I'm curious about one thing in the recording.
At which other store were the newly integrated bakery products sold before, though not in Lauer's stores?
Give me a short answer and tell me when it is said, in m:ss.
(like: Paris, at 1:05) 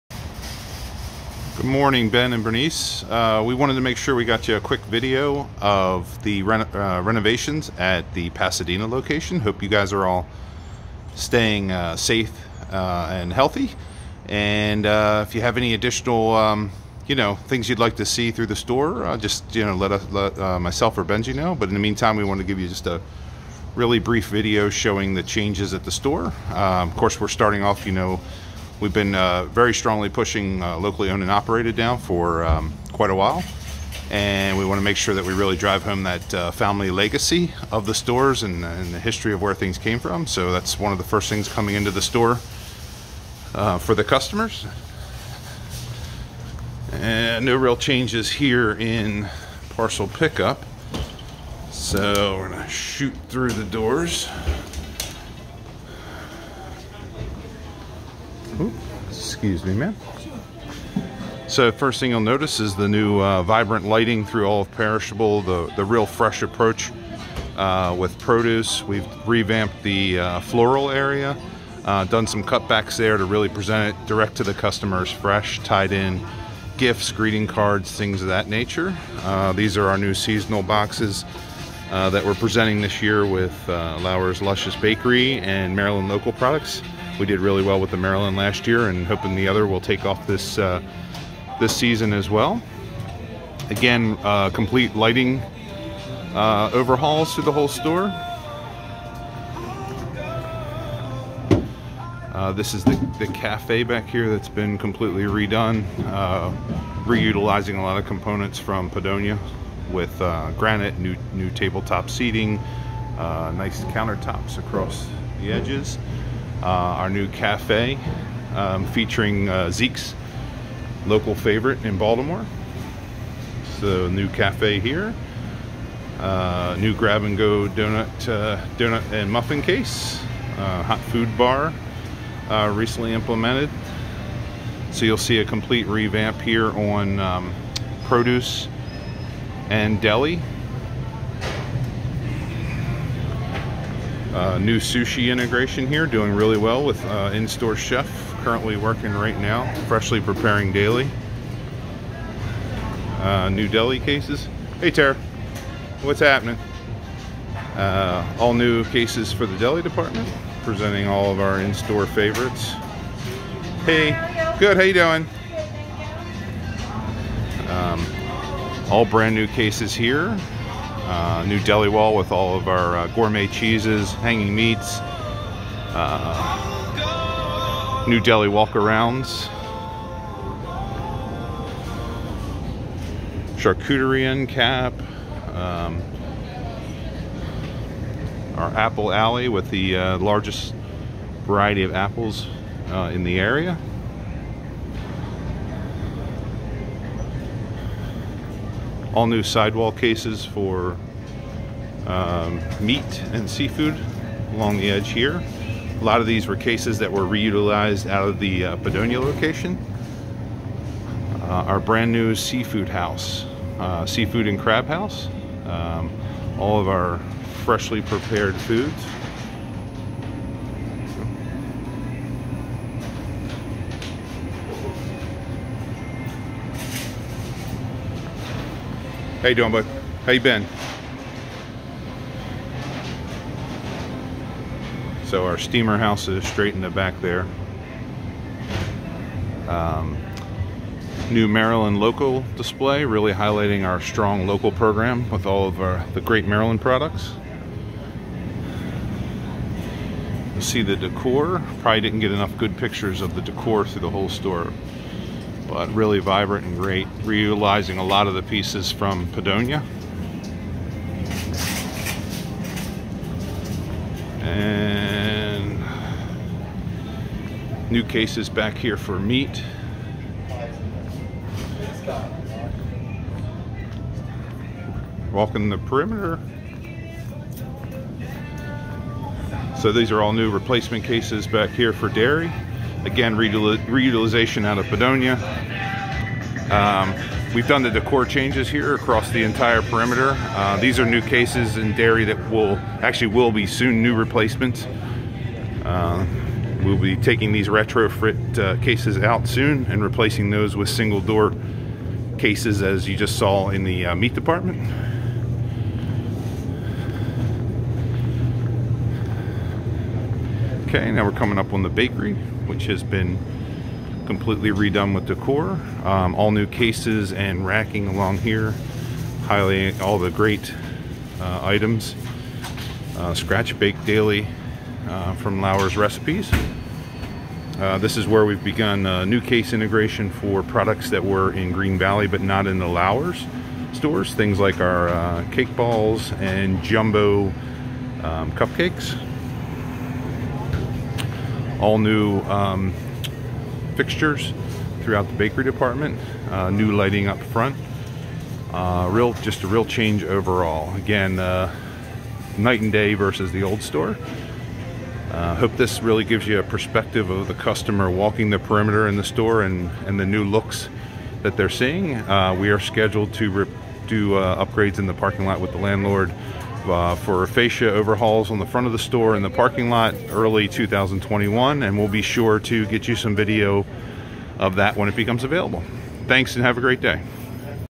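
Green Valley, at 5:31.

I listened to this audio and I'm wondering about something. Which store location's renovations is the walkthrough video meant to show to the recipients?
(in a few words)
Pasadena.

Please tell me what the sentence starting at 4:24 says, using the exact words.
And new cases back here for meat.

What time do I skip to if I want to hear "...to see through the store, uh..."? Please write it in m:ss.
0:17.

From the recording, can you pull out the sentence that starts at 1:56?
Uh, our new cafe um, featuring uh, Zeke's local favorite in Baltimore.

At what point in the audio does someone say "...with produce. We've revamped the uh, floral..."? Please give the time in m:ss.
1:07.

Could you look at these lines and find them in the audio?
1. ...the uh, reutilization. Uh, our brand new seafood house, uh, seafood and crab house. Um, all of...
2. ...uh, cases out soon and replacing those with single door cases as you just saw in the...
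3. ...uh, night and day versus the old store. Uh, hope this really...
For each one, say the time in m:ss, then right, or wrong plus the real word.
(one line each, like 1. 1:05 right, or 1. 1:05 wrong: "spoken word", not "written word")
1. 3:28 wrong: "location", not "reutilization"
2. 4:58 right
3. 5:51 right.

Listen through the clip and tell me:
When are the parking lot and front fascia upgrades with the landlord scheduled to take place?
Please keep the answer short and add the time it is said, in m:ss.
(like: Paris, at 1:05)
early 2021, at 6:10.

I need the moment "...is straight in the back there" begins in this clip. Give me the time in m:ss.
3:56.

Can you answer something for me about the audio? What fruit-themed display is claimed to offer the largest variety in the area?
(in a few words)
apple alley.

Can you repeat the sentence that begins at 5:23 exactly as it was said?
Uh, scratch Bake Daily uh, from Lauer's Recipes.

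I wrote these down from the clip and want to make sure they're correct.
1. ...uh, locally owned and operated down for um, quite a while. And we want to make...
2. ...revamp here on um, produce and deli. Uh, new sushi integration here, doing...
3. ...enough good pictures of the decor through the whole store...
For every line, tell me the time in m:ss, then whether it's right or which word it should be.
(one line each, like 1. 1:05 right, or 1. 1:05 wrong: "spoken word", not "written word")
1. 0:30 right
2. 2:15 right
3. 4:12 right.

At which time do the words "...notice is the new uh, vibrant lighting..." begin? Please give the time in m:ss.
1:02.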